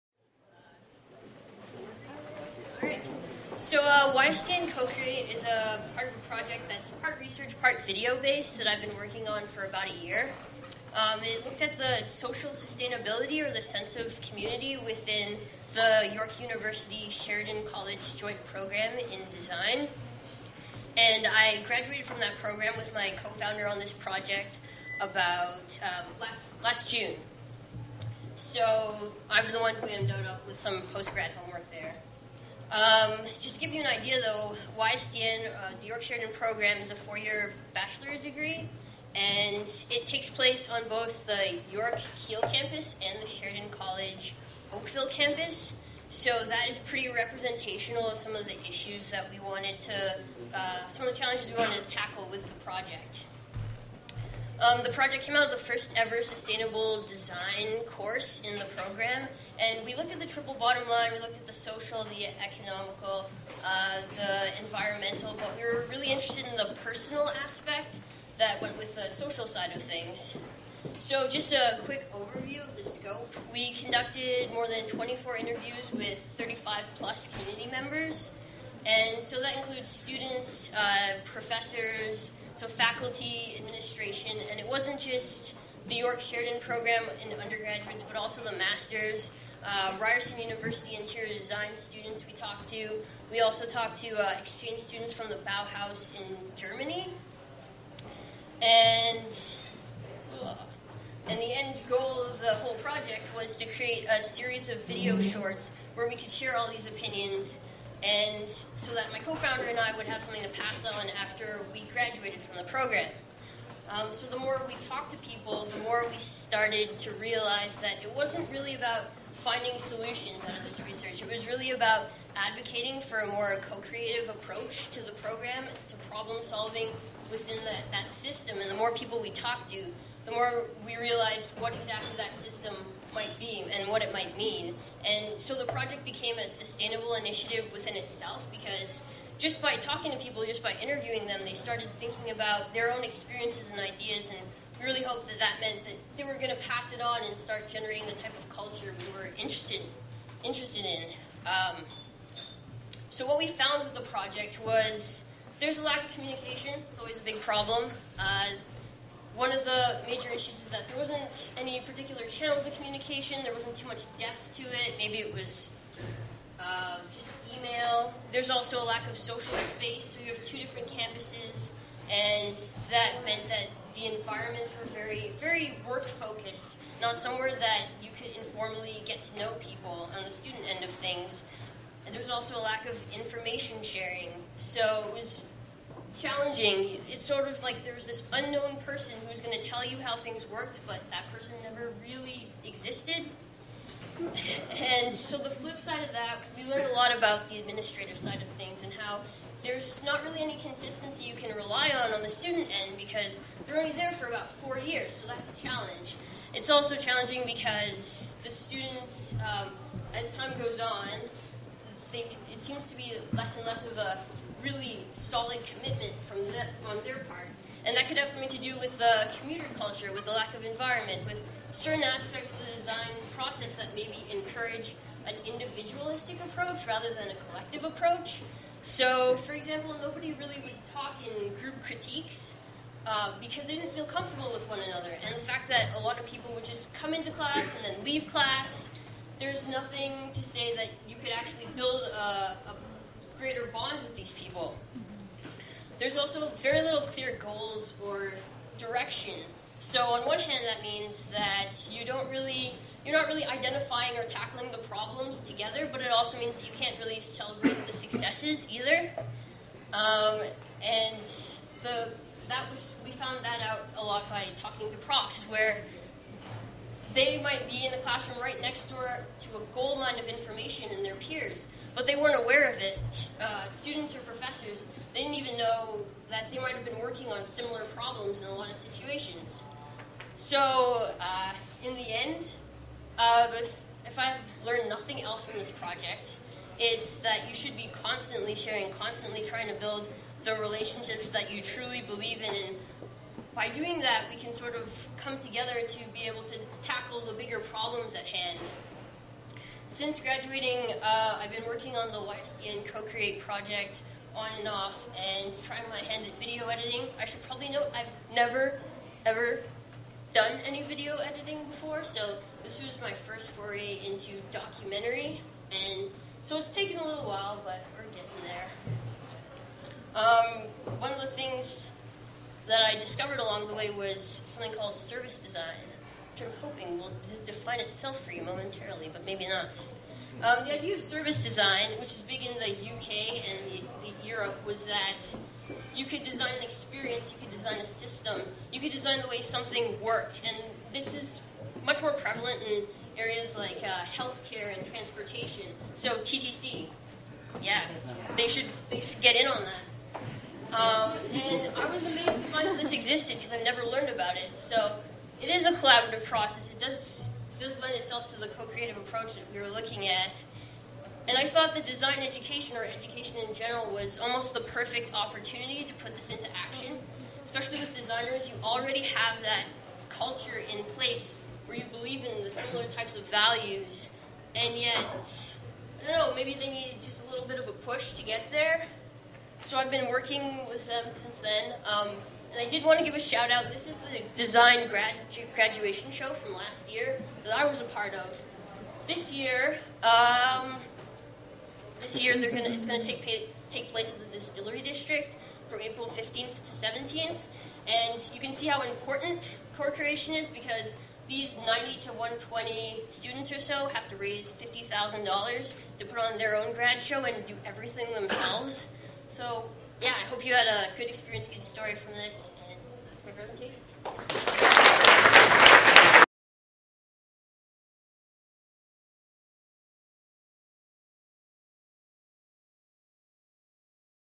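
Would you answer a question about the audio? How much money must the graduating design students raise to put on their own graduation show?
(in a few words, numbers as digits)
$50,000.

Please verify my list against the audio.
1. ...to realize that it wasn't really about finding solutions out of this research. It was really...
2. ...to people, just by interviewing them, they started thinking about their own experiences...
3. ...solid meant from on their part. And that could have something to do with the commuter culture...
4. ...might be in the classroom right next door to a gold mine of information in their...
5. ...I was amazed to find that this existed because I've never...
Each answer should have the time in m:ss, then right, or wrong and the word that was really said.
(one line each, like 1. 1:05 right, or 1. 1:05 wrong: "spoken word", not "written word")
1. 1:56 right
2. 2:20 right
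3. 3:35 wrong: "commitment", not "meant"
4. 4:27 right
5. 5:51 right.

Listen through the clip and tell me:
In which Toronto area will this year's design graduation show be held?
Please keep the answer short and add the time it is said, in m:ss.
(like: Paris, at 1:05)
Distillery District, at 6:34.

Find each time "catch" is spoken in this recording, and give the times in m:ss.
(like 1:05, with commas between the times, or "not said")
not said.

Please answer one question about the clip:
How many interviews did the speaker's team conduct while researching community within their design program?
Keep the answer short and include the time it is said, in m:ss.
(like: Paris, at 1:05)
more than 24, at 1:14.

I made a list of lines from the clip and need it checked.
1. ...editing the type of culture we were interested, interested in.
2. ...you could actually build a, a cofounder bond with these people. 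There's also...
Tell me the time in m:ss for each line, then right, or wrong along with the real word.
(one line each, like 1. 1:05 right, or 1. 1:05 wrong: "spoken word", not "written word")
1. 2:27 wrong: "generating", not "editing"
2. 4:01 wrong: "greater", not "cofounder".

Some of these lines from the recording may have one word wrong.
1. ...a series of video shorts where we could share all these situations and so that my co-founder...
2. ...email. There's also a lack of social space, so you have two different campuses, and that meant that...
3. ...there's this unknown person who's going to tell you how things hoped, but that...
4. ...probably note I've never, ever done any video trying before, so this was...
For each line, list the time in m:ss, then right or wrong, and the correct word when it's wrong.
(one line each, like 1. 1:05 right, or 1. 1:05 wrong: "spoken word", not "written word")
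1. 1:44 wrong: "opinions", not "situations"
2. 2:47 right
3. 3:07 wrong: "worked", not "hoped"
4. 5:07 wrong: "editing", not "trying".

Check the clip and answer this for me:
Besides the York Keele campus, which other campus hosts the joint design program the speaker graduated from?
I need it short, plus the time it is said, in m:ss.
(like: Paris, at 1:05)
Sheridan College Oakville campus, at 0:43.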